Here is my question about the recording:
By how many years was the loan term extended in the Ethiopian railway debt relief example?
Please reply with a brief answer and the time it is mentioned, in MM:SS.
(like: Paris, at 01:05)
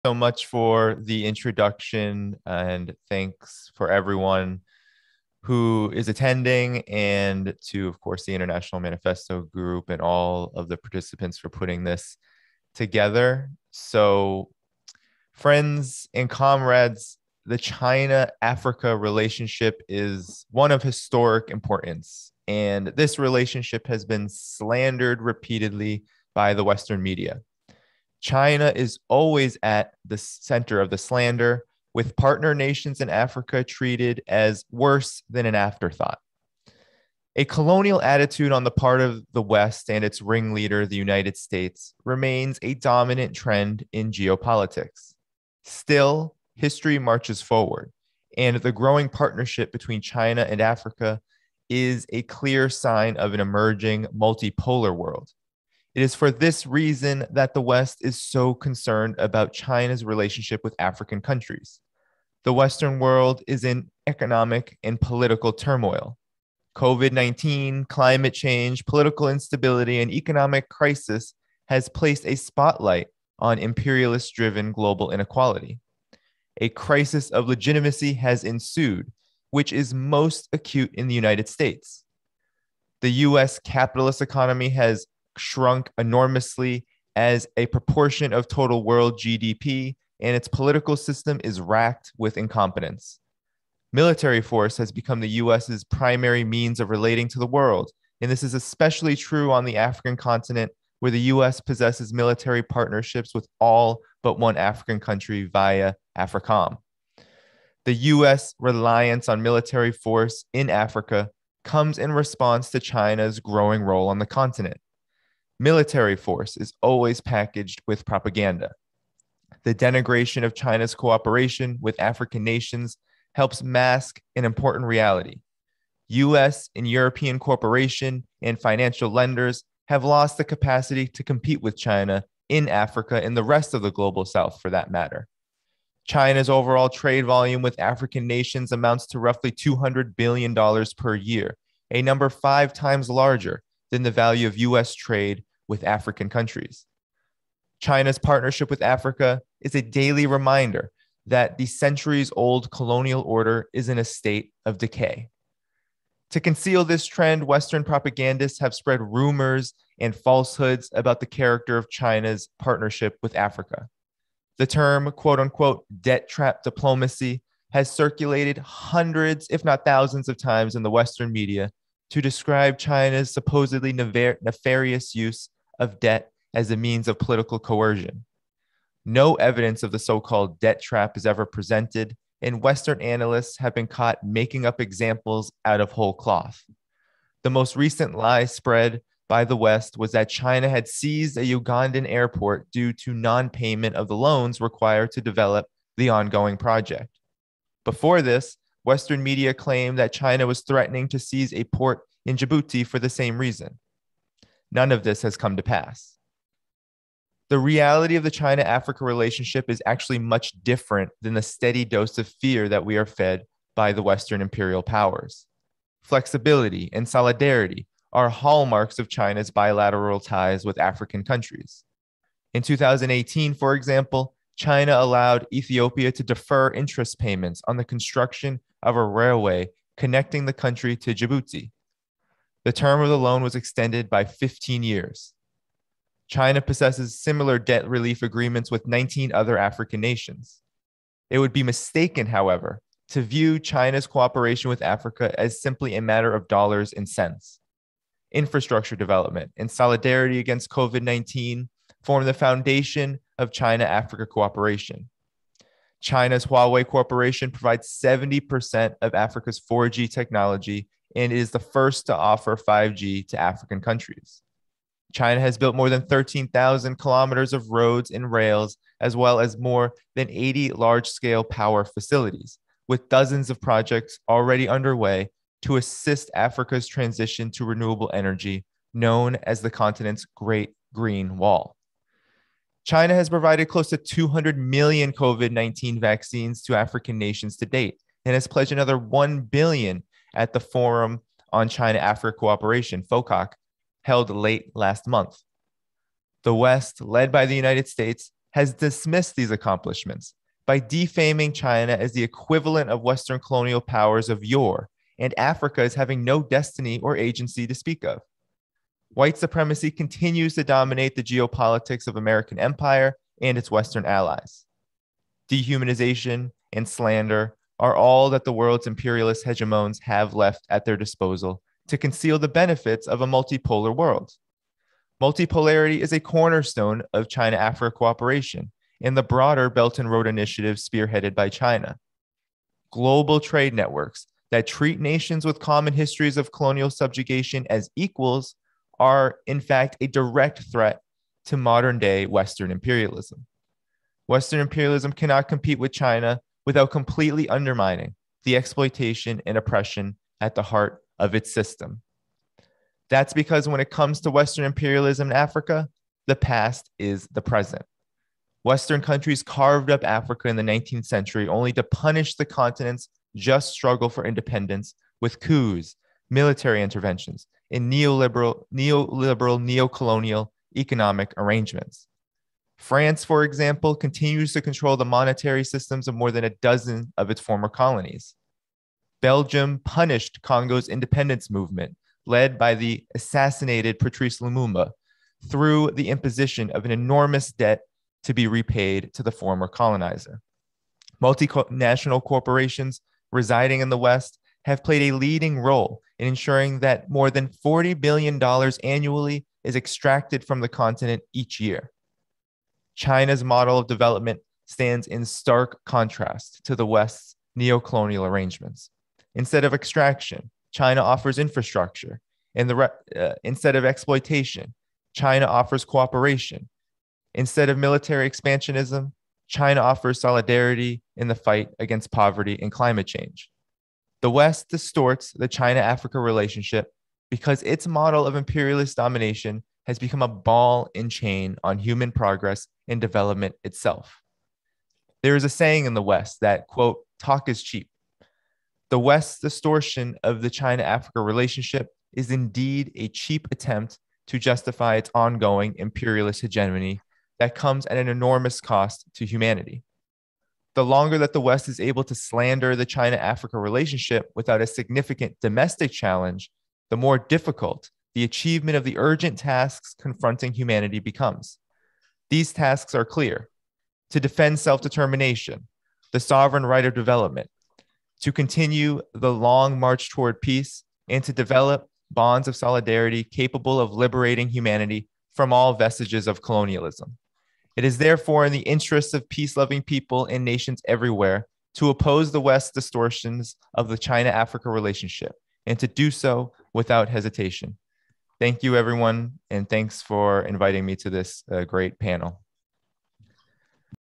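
15, at 03:54.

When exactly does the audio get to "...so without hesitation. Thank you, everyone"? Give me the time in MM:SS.
08:06.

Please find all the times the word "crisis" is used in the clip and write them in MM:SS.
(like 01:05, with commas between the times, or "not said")
01:10, 01:16.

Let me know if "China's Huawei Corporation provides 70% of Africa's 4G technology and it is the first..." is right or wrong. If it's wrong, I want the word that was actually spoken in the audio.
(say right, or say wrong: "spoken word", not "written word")
right.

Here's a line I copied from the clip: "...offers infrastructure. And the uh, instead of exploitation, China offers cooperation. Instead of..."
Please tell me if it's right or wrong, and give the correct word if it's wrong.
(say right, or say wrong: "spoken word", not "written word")
right.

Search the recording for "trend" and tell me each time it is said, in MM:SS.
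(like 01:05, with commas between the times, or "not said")
00:43, 02:37.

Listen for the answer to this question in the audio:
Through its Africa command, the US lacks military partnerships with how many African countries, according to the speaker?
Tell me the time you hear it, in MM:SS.
01:43.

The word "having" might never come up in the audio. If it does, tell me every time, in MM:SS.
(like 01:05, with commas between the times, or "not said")
05:05.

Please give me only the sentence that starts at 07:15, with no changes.
There is a saying in the West that, quote, talk is cheap.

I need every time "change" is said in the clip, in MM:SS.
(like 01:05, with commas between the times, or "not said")
01:08, 07:03.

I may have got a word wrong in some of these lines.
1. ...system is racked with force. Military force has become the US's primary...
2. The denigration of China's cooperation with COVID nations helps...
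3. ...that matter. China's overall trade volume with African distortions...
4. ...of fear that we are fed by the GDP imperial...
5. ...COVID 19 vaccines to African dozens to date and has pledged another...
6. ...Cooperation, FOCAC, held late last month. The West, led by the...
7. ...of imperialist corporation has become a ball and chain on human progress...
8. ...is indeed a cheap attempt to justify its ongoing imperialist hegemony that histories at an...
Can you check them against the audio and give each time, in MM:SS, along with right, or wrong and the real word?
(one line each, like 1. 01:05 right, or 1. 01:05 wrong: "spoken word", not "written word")
1. 01:30 wrong: "incompetence", not "force"
2. 01:59 wrong: "African", not "COVID"
3. 02:14 wrong: "nations", not "distortions"
4. 03:32 wrong: "Western", not "GDP"
5. 04:45 wrong: "nations", not "dozens"
6. 04:52 right
7. 07:08 wrong: "domination", not "corporation"
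8. 07:22 wrong: "comes", not "histories".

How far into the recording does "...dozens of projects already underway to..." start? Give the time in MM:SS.
04:33.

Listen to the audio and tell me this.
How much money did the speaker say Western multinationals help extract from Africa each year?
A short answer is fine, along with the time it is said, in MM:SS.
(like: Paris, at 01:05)
$40 billion, at 06:37.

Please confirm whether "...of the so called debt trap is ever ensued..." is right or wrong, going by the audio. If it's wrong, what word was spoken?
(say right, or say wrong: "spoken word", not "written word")
wrong: "presented", not "ensued".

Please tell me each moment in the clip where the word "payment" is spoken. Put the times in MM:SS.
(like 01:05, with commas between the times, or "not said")
03:13, 03:47.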